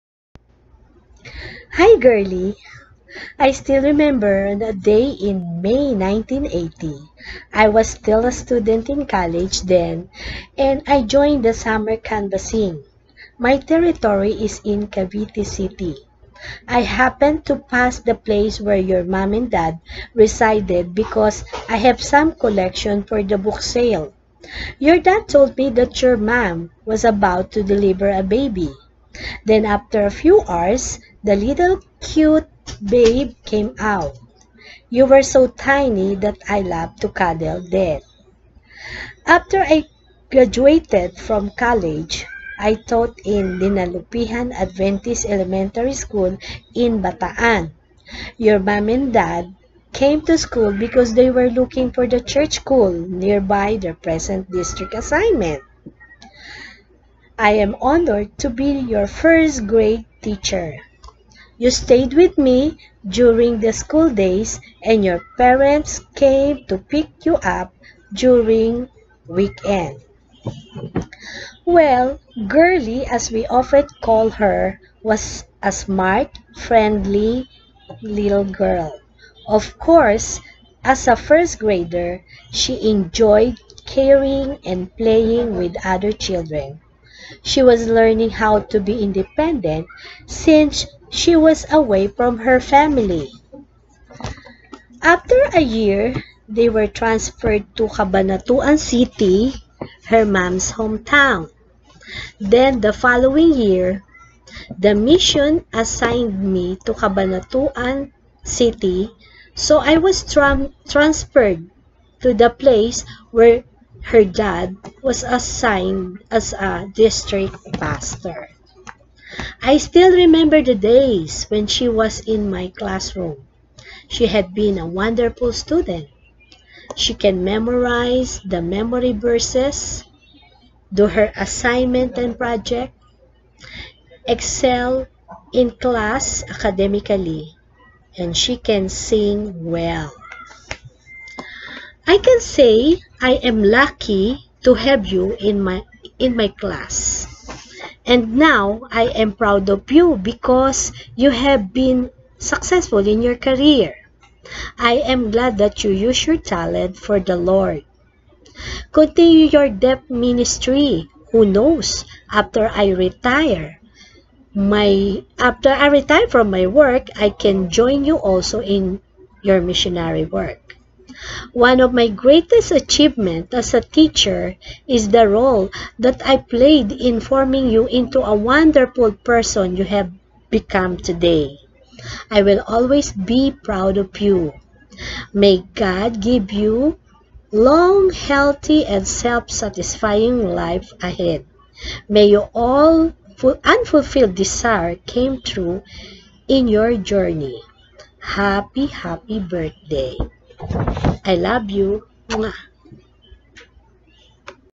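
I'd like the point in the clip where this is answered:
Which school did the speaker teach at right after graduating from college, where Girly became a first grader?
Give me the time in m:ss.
0:43.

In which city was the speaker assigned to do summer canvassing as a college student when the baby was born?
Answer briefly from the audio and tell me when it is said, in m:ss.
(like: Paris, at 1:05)
Cavite City, at 0:14.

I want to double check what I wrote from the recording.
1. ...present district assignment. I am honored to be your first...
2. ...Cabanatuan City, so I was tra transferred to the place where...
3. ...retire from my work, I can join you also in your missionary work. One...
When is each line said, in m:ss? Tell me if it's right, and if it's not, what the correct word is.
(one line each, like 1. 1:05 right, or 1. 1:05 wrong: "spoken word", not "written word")
1. 0:53 right
2. 1:46 right
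3. 2:45 right.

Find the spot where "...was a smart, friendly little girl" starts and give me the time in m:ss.
1:15.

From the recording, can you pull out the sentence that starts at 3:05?
May God give you long, healthy, and self-satisfying life ahead.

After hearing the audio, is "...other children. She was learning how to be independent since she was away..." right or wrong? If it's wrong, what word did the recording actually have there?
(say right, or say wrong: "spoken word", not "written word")
right.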